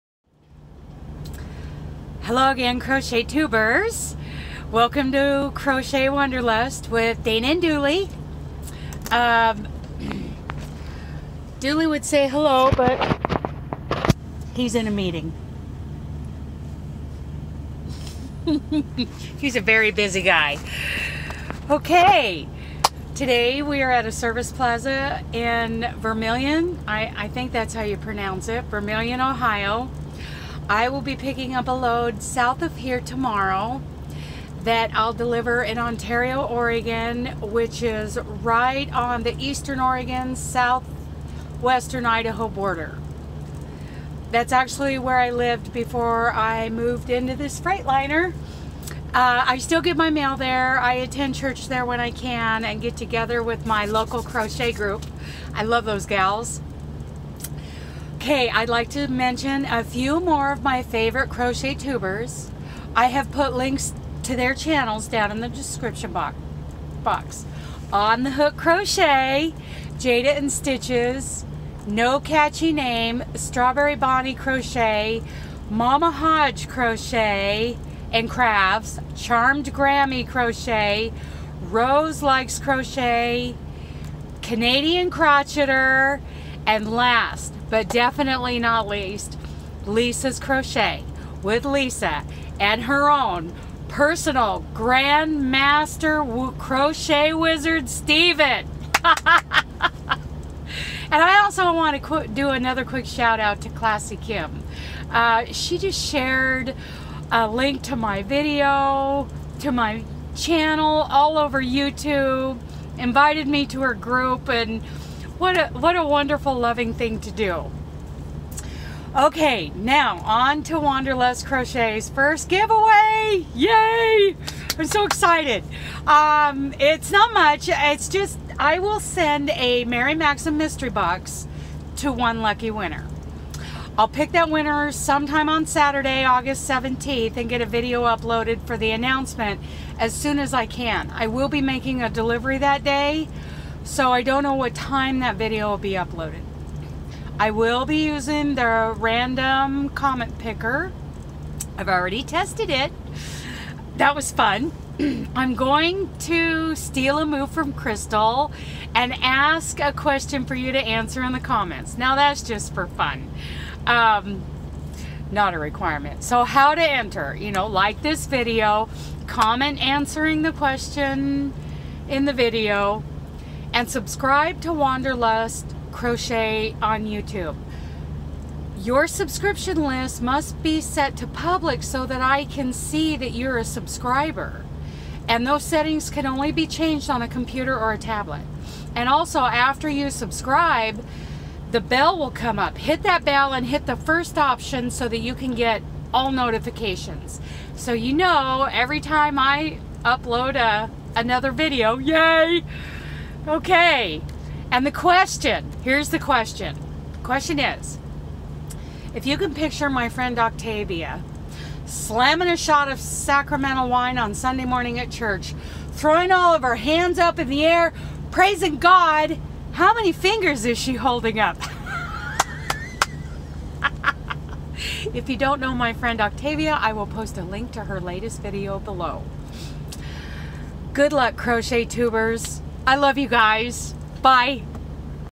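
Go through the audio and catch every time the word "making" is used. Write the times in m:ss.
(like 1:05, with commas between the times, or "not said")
2:21.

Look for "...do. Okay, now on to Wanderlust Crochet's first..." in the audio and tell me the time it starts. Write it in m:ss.
1:57.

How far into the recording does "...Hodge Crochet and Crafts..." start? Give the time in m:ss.
1:16.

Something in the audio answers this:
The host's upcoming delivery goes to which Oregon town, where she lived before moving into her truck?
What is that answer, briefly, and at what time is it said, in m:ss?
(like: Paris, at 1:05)
Ontario, at 0:35.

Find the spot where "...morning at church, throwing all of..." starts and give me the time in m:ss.
3:34.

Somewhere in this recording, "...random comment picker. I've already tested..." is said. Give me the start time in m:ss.
2:28.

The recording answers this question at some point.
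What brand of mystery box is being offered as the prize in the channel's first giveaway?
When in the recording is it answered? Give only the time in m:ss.
2:09.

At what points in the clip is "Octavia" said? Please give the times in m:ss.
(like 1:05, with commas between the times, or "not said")
3:30, 3:46.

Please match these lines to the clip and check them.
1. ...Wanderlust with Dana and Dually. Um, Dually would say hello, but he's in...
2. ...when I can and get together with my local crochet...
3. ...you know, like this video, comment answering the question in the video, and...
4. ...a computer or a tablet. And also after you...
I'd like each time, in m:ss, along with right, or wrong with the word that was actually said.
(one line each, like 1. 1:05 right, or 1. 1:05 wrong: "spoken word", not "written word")
1. 0:06 right
2. 0:51 right
3. 2:47 right
4. 3:07 right.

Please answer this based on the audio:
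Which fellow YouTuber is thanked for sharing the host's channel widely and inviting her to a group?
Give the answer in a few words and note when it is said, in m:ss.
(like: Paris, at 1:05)
Classy Kim, at 1:43.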